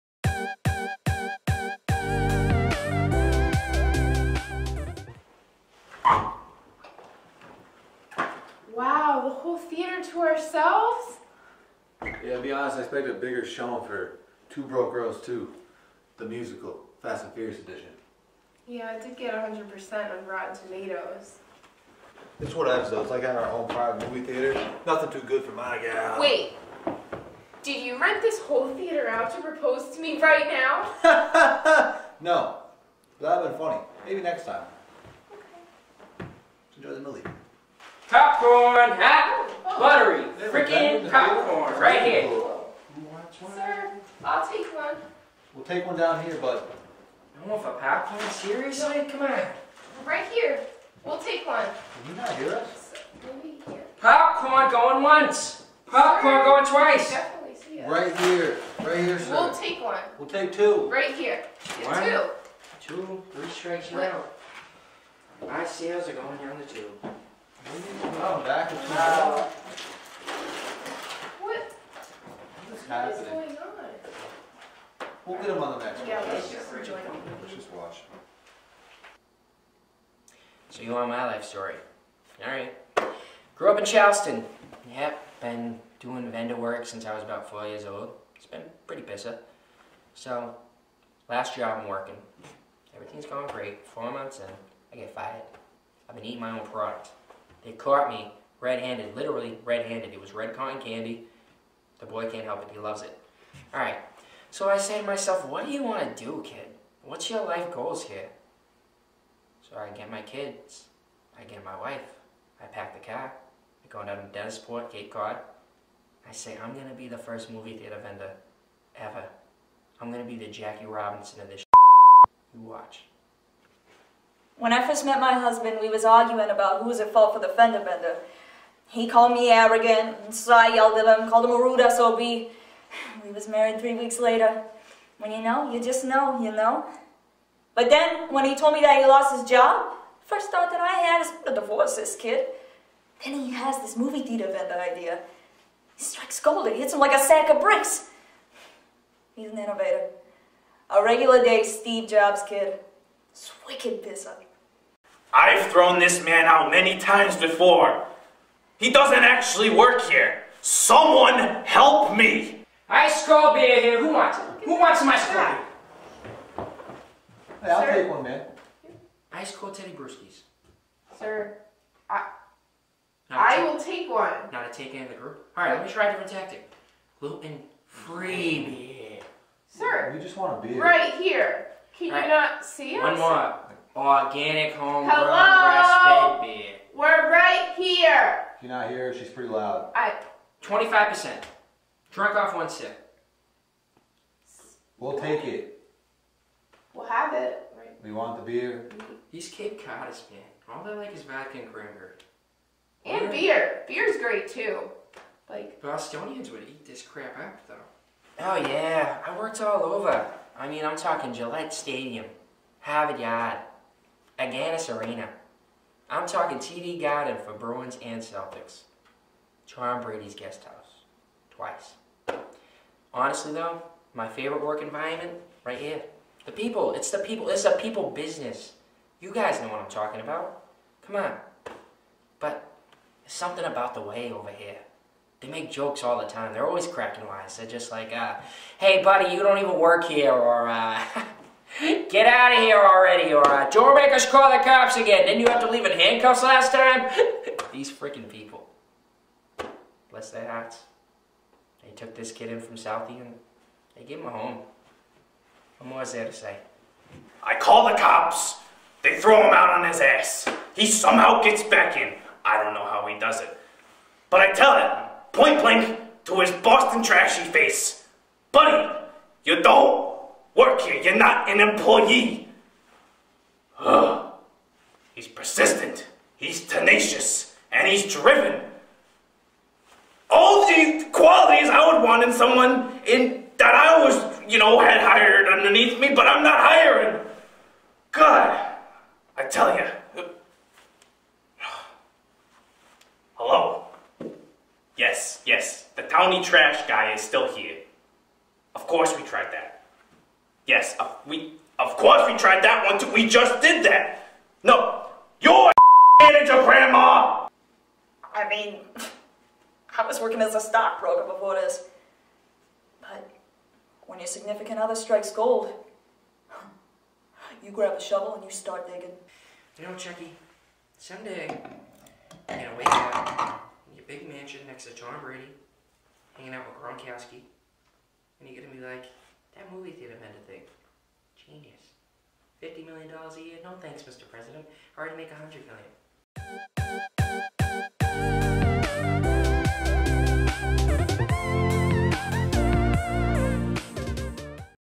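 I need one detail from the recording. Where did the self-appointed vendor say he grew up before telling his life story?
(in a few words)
Charleston.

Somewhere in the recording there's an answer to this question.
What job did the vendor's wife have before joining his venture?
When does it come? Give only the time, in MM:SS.
05:10.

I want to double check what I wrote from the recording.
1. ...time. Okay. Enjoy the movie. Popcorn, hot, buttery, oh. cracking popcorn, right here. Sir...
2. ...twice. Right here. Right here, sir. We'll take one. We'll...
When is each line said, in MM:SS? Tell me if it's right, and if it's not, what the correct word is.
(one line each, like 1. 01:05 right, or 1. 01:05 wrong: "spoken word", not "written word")
1. 00:34 wrong: "freaking", not "cracking"
2. 00:56 right.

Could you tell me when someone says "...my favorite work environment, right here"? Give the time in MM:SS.
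03:44.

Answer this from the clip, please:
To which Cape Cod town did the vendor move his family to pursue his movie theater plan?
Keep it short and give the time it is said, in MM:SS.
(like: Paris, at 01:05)
Dennisport, at 01:54.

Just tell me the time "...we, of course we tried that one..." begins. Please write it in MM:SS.
05:01.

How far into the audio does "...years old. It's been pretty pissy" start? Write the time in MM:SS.
01:27.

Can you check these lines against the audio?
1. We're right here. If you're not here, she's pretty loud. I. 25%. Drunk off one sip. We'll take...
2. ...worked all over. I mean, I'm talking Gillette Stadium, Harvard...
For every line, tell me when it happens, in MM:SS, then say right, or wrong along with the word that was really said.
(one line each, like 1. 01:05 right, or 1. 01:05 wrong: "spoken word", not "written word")
1. 03:06 right
2. 03:29 right.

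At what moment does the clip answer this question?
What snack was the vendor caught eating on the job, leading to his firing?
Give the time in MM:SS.
01:40.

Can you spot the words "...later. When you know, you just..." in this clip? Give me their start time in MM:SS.
02:14.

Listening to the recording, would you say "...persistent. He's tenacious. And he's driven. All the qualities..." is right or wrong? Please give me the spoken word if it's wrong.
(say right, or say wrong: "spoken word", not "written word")
right.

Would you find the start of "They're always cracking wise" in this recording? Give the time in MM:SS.
03:56.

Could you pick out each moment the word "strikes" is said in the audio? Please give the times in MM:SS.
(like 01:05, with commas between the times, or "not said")
01:03, 02:26, 05:14.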